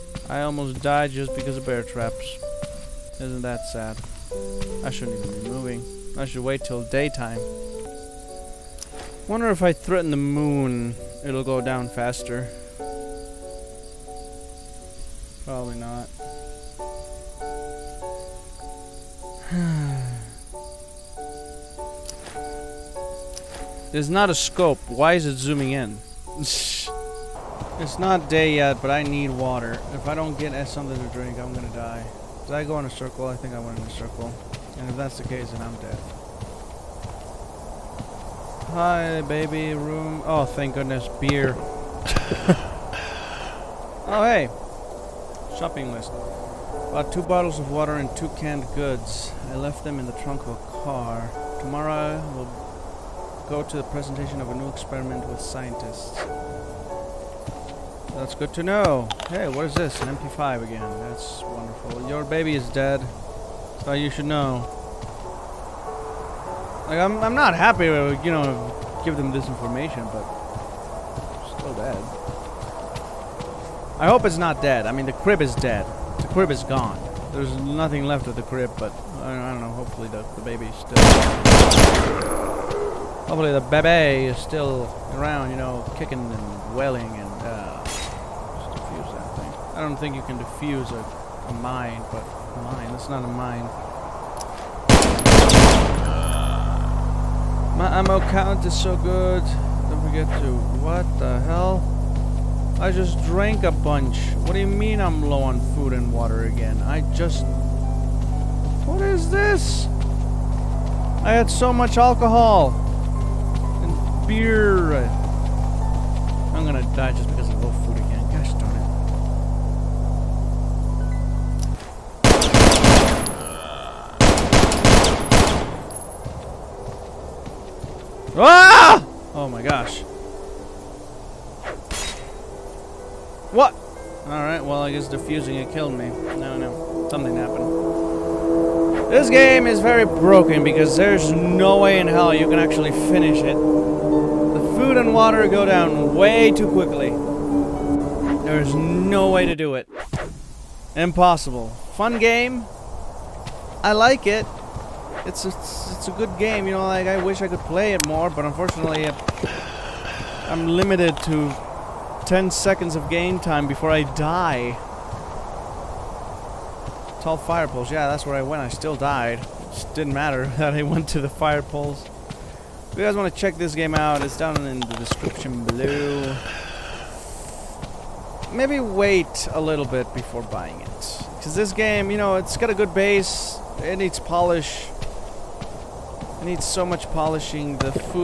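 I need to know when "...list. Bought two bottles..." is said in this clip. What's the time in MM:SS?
00:45.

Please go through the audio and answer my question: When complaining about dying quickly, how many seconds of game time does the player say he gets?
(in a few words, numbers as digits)
10.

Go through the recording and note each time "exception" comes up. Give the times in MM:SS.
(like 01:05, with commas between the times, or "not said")
not said.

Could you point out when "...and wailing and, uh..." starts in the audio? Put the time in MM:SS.
01:26.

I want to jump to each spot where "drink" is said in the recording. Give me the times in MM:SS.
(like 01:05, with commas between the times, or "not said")
00:31.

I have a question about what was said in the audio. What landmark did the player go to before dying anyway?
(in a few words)
Tall fire poles.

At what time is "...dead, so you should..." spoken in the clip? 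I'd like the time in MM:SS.
01:02.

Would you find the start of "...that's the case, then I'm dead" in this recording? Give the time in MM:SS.
00:34.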